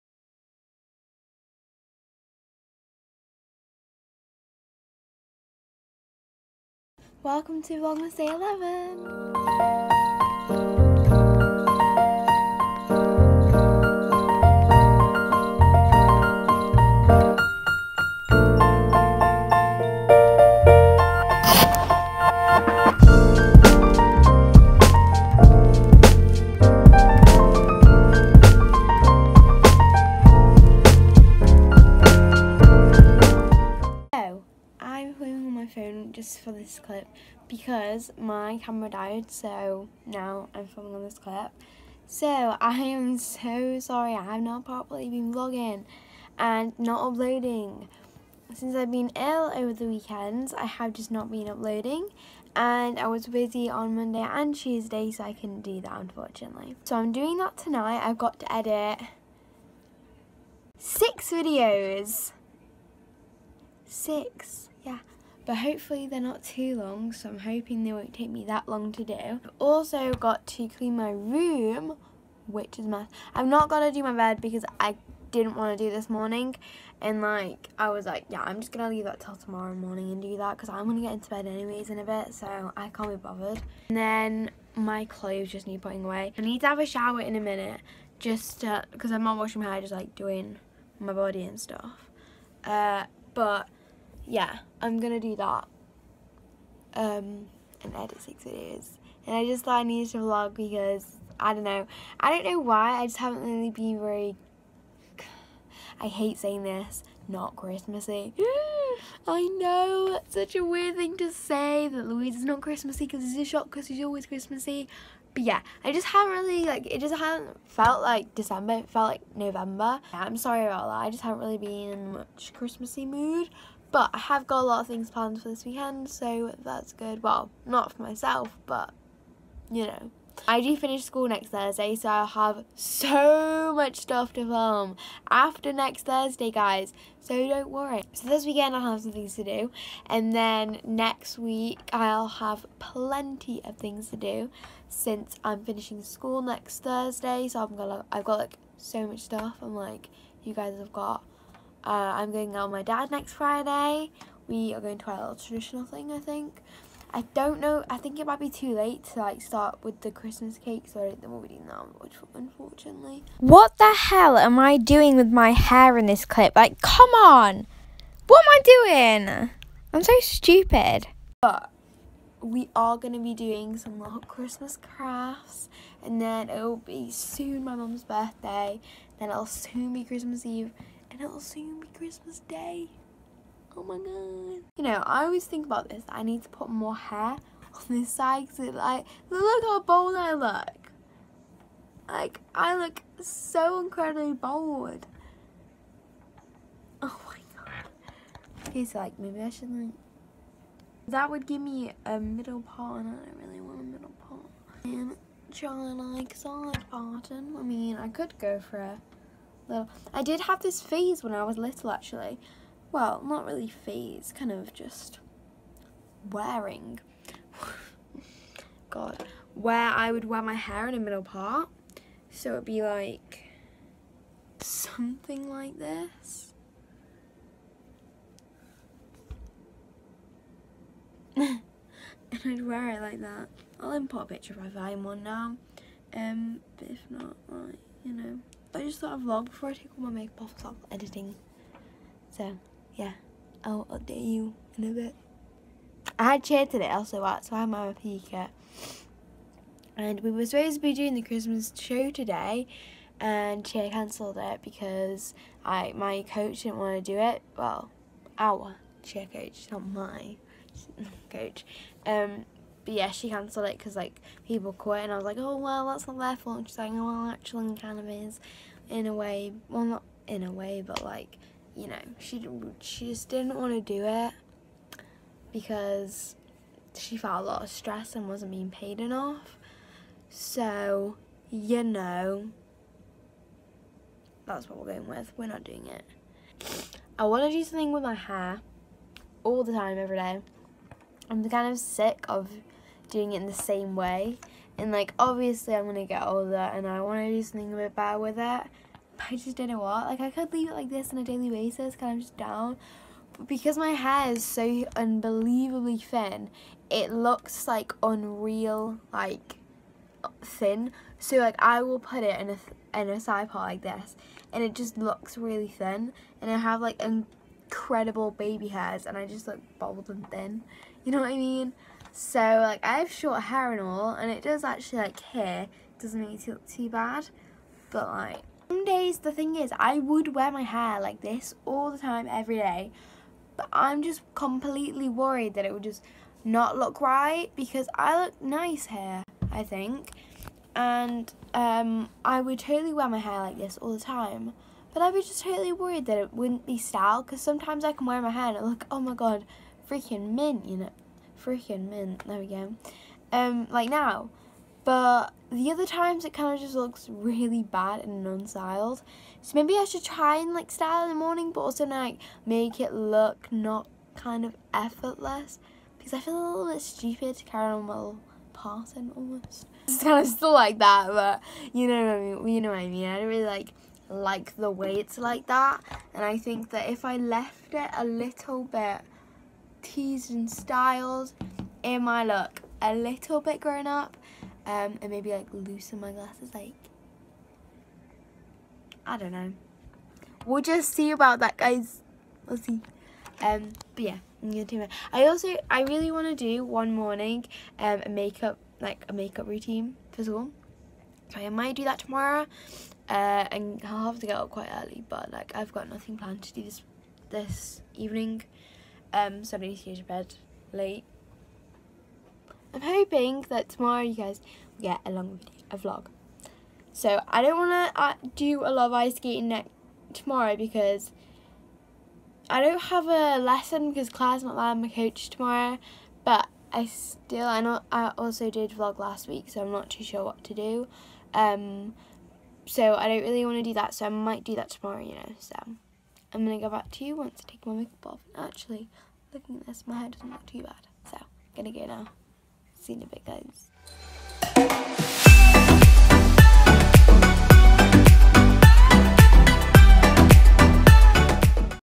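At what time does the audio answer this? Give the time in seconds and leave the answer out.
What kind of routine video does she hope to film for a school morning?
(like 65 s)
399 s.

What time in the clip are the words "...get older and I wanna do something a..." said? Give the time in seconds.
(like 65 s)
296 s.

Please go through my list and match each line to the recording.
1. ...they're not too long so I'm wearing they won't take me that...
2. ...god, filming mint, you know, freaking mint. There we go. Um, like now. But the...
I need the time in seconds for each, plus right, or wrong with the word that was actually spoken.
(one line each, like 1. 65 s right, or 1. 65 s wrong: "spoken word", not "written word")
1. 66 s wrong: "hoping", not "wearing"
2. 349 s wrong: "freaking", not "filming".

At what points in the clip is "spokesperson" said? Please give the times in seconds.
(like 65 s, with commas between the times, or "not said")
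not said.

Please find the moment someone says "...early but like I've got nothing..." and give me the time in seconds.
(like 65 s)
404 s.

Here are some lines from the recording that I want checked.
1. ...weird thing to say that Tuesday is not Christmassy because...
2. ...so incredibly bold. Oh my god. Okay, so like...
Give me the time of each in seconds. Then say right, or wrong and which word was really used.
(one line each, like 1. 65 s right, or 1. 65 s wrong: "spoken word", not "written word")
1. 110 s wrong: "Louise", not "Tuesday"
2. 193 s right.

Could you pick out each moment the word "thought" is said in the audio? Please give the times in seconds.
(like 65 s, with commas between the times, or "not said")
99 s, 238 s.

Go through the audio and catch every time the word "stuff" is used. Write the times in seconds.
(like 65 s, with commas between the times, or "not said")
91 s, 133 s, 149 s.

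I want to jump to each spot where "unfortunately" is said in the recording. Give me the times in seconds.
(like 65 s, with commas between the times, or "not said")
55 s, 162 s.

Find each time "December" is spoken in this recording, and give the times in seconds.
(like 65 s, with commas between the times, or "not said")
118 s.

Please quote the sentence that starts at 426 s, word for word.
But I still, I know I also did vlog last week, so I'm not too sure what to do.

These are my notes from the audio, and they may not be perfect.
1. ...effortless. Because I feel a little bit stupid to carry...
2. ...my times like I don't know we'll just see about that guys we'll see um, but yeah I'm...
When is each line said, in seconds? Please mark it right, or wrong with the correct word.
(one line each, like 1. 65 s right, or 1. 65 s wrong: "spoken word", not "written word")
1. 364 s right
2. 385 s wrong: "glasses", not "times".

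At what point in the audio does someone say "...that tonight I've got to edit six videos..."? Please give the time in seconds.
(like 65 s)
57 s.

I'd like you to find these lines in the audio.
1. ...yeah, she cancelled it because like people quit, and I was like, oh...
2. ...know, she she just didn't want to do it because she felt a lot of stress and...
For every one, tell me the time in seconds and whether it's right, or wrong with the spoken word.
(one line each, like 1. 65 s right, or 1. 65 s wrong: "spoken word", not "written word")
1. 262 s right
2. 271 s right.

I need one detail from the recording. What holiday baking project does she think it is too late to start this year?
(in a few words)
Christmas cake.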